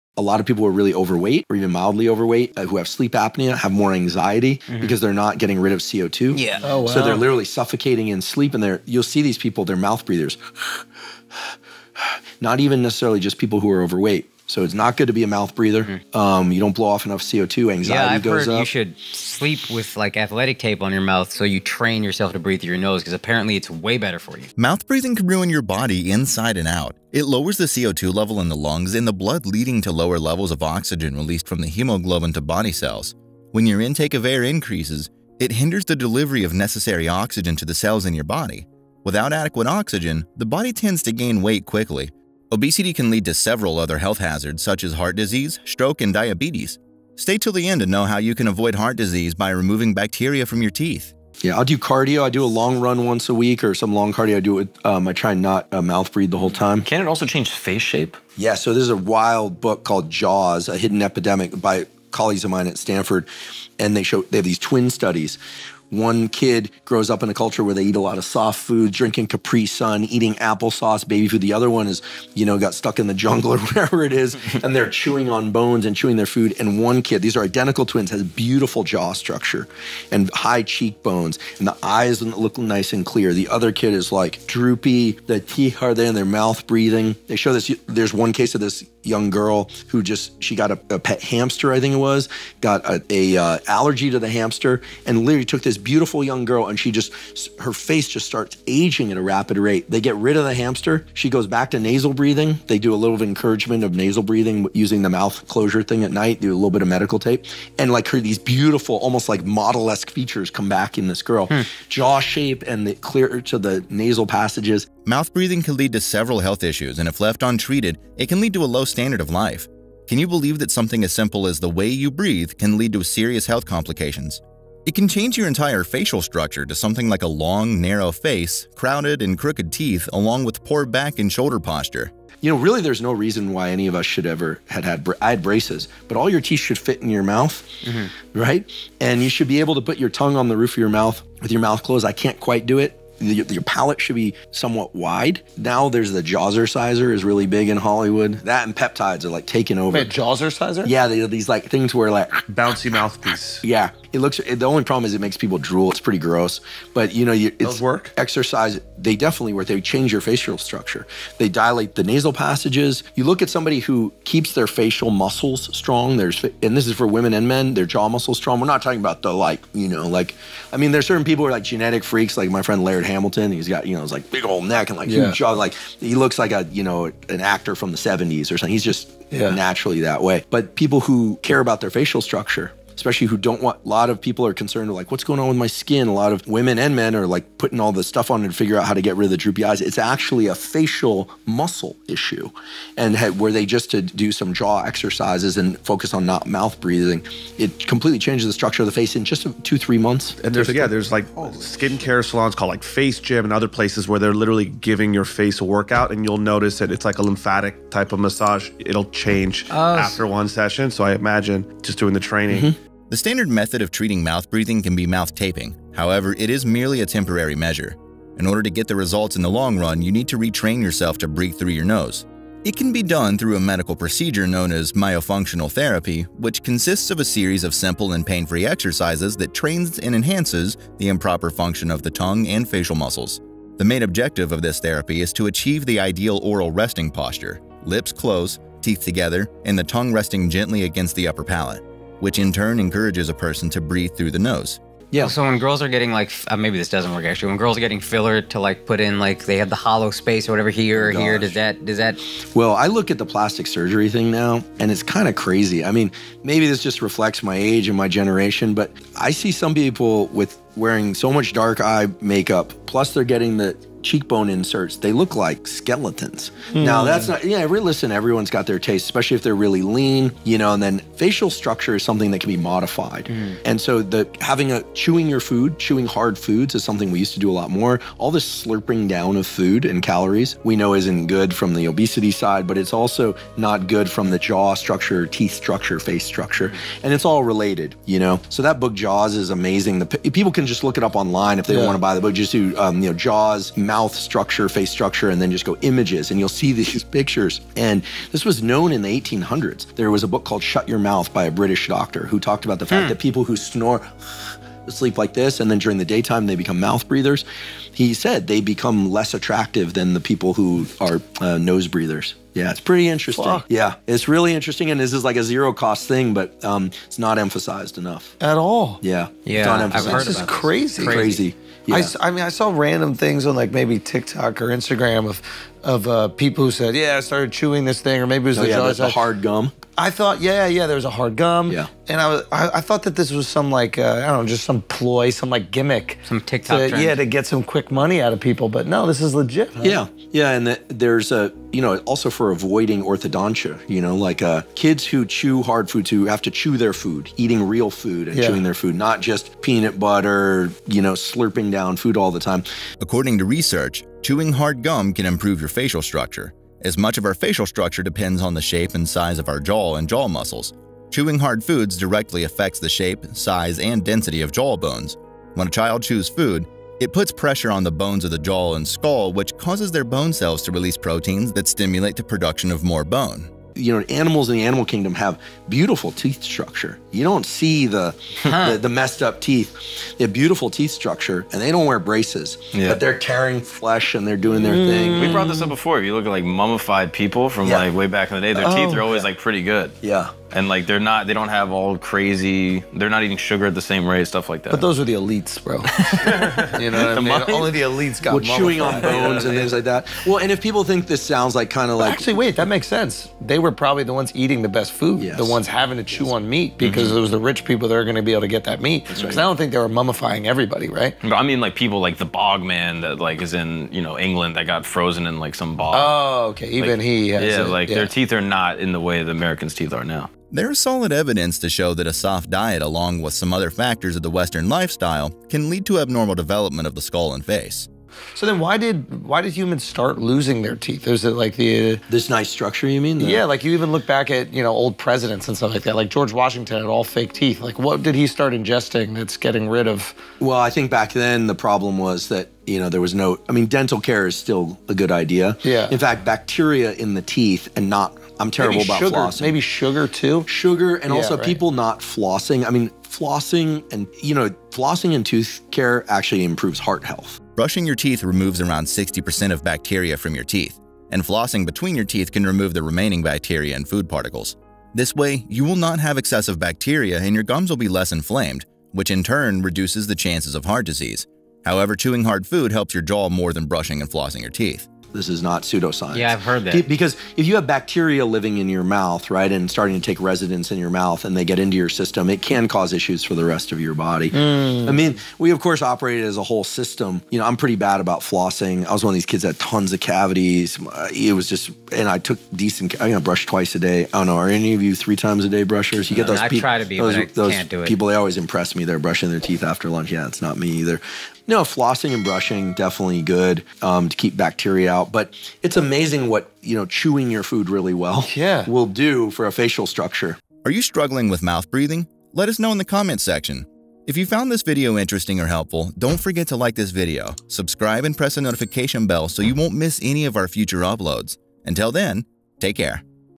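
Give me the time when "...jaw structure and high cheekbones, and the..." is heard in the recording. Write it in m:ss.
1:18.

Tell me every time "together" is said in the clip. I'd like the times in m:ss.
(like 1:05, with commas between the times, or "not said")
3:59.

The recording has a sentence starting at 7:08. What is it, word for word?
So then why did why did humans start losing their teeth?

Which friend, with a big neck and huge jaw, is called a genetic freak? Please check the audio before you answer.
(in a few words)
Laird Hamilton.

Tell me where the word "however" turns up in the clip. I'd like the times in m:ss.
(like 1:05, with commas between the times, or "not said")
3:35, 7:51.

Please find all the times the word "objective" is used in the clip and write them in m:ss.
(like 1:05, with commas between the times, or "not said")
3:54.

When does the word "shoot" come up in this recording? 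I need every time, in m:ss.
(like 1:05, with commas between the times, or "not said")
not said.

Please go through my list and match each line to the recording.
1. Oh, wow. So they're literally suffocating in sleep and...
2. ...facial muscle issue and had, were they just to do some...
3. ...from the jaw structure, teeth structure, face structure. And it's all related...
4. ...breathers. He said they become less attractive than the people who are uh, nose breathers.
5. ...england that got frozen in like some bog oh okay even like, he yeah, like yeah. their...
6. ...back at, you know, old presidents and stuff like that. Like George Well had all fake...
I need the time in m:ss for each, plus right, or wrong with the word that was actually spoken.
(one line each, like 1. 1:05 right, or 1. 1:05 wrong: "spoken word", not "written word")
1. 0:06 right
2. 3:10 right
3. 4:44 right
4. 5:07 right
5. 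6:54 right
6. 7:14 wrong: "Washington", not "Well".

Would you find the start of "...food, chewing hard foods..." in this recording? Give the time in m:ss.
4:35.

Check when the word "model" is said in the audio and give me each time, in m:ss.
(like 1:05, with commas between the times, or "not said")
1:49.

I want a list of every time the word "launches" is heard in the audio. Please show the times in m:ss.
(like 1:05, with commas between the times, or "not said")
not said.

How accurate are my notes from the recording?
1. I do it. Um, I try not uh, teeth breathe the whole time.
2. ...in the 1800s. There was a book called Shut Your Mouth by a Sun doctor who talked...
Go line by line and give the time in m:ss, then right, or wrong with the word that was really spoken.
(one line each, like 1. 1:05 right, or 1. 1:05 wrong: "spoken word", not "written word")
1. 0:54 wrong: "mouth", not "teeth"
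2. 4:58 wrong: "British", not "Sun".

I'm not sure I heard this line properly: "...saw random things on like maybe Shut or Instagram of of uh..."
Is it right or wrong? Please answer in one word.
wrong.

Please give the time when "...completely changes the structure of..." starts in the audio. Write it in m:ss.
3:17.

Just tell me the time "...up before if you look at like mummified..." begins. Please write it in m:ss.
6:25.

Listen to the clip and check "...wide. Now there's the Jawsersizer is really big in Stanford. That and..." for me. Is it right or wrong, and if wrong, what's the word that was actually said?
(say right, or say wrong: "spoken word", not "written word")
wrong: "Hollywood", not "Stanford".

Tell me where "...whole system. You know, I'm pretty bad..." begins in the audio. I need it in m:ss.
8:06.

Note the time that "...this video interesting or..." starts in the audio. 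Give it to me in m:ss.
8:34.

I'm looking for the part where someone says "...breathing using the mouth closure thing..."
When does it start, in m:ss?
1:44.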